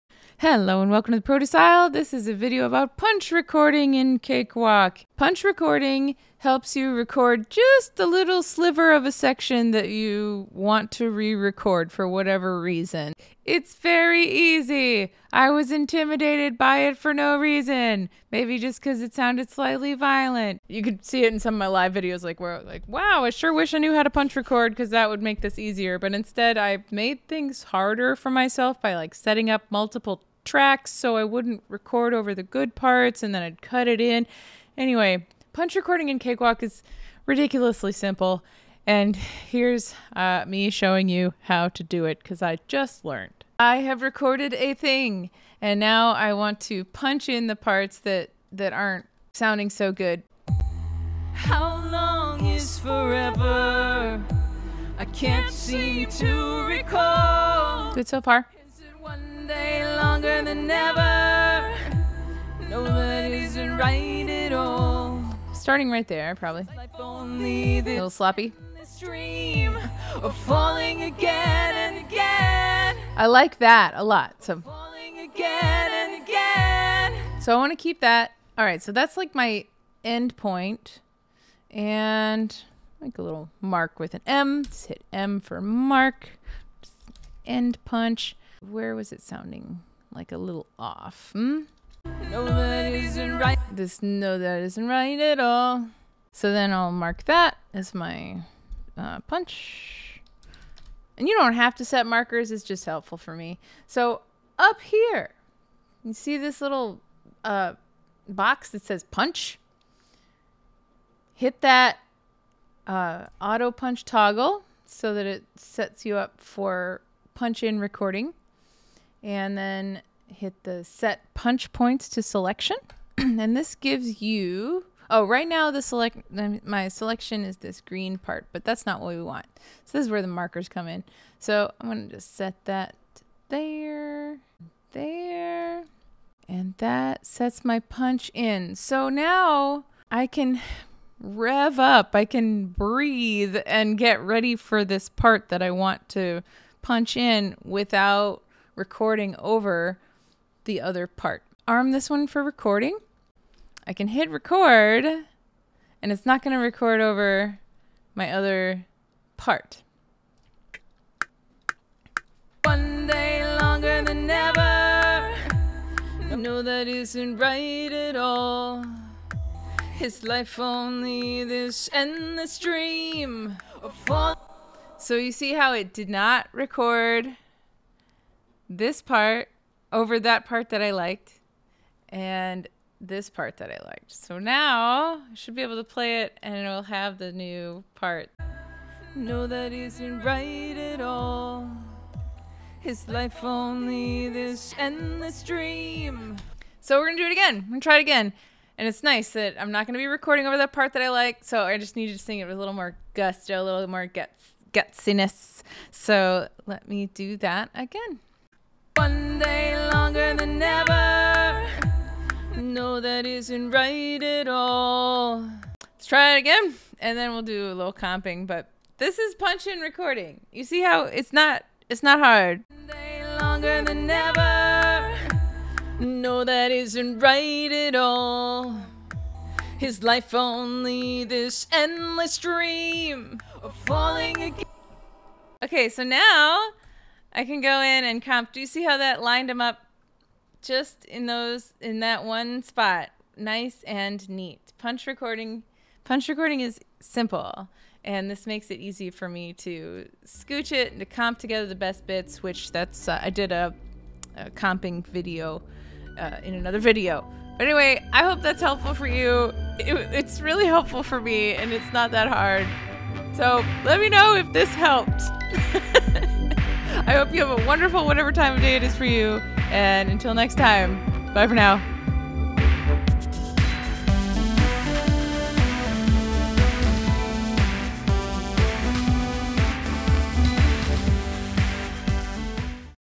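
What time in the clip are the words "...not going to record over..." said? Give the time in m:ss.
2:36.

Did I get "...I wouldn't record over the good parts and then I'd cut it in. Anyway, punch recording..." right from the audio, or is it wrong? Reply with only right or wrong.
right.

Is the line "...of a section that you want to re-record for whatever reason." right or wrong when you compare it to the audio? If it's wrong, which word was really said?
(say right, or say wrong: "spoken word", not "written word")
right.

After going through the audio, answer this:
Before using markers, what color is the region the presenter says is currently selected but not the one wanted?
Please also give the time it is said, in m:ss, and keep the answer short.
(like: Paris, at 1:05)
green, at 2:07.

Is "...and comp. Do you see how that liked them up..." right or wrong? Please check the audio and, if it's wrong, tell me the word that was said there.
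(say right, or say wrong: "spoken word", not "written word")
wrong: "lined", not "liked".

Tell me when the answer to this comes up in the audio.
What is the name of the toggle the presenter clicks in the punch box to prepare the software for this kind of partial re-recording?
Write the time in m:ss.
1:53.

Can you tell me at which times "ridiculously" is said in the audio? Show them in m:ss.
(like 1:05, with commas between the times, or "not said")
0:37.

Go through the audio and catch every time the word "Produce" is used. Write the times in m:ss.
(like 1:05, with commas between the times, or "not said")
0:01.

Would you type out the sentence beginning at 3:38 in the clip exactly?
But this is punch in recording.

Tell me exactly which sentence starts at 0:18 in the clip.
Maybe just because it sounded slightly violent.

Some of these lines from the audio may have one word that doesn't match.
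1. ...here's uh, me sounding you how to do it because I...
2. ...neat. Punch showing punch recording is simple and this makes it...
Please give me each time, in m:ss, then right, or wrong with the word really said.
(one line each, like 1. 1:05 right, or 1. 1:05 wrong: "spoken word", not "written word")
1. 0:39 wrong: "showing", not "sounding"
2. 4:04 wrong: "recording", not "showing".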